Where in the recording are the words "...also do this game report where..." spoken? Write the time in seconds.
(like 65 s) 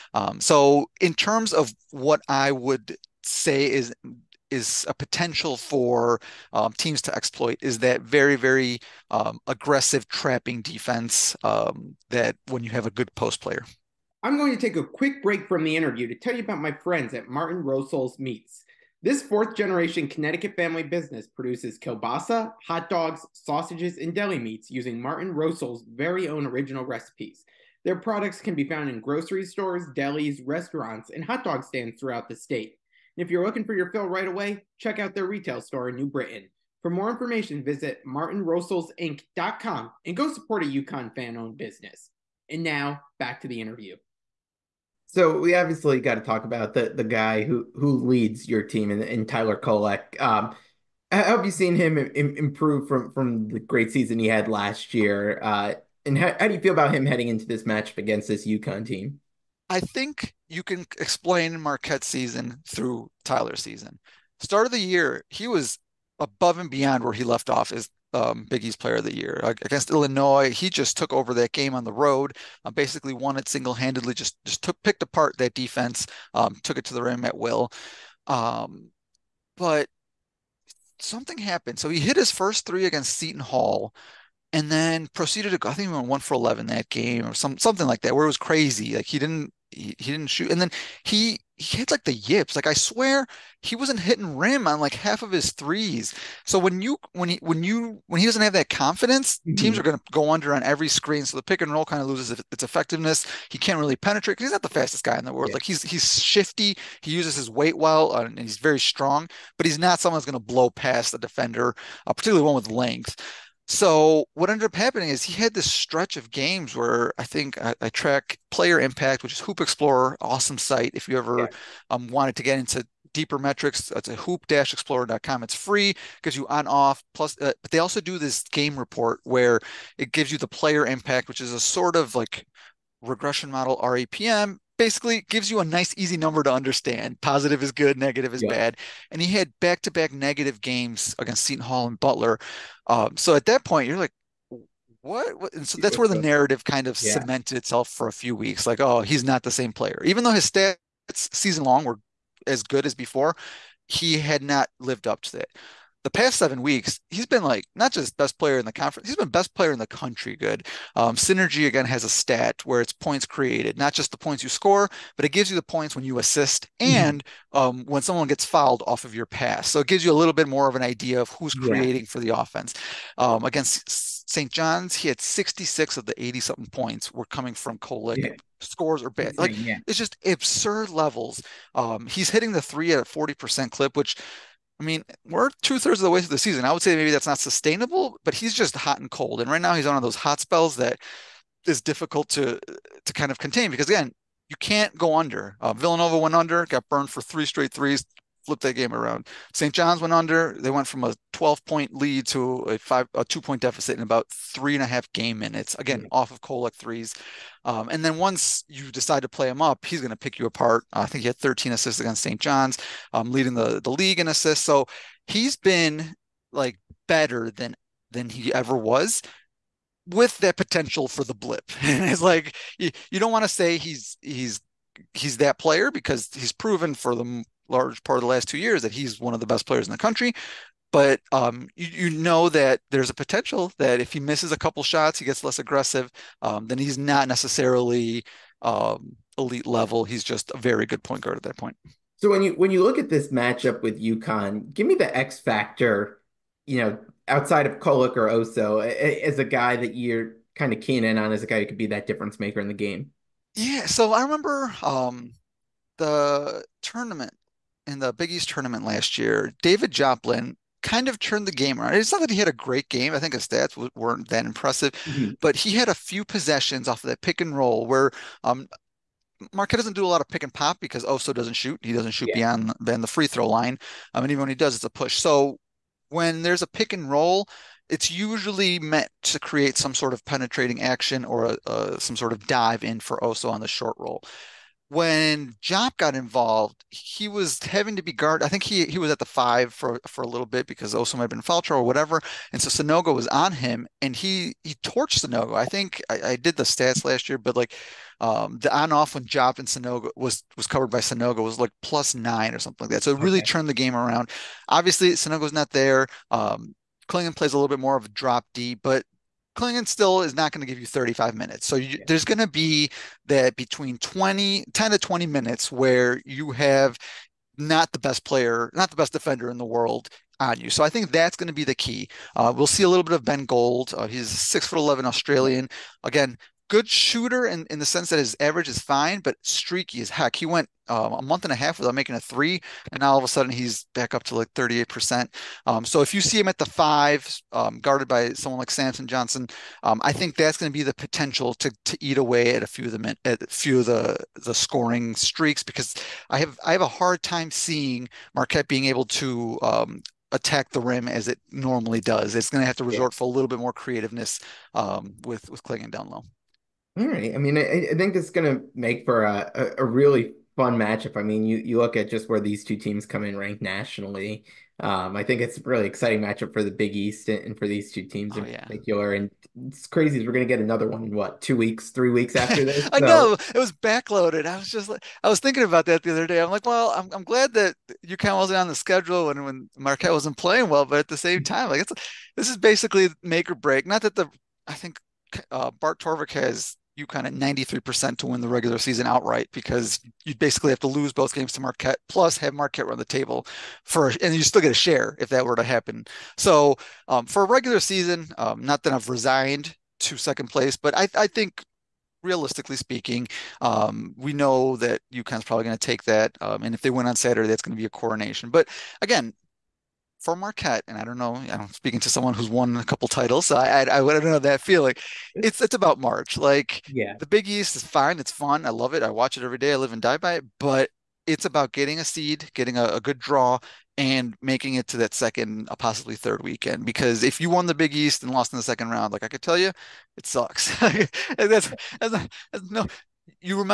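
127 s.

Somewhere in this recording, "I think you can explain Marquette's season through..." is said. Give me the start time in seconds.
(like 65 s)
59 s.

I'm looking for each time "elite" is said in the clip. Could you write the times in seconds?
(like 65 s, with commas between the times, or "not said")
239 s.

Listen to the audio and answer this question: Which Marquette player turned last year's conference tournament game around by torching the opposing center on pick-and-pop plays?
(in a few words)
David Joplin.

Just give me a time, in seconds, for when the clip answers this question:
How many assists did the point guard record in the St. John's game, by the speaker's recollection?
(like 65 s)
211 s.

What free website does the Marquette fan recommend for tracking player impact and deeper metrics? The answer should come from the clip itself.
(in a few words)
Hoop Explorer.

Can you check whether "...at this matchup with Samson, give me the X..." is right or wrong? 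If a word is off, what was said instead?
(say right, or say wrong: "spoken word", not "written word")
wrong: "UConn", not "Samson".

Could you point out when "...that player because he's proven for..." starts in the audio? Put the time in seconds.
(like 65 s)
225 s.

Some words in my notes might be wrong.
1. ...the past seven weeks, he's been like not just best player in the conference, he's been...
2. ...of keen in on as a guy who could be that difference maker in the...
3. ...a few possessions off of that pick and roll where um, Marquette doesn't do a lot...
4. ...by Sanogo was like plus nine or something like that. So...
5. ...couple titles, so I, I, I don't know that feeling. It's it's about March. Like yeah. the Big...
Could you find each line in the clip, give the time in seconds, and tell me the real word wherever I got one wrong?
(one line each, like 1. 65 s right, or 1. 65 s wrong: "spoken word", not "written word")
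1. 156 s right
2. 250 s right
3. 265 s right
4. 300 s right
5. 412 s right.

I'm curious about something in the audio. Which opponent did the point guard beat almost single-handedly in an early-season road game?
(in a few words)
Illinois.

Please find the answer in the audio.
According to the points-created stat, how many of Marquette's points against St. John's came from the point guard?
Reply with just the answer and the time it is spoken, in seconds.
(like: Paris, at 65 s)
66, at 175 s.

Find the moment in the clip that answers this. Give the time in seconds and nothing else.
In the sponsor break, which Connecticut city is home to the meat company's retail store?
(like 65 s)
35 s.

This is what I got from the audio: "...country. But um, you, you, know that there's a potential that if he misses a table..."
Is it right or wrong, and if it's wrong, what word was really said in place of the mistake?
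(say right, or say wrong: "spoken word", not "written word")
wrong: "couple", not "table".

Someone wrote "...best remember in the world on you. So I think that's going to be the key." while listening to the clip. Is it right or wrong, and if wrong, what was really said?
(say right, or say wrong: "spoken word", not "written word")
wrong: "defender", not "remember".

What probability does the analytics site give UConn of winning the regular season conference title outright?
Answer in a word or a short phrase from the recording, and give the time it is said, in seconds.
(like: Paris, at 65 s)
93%, at 387 s.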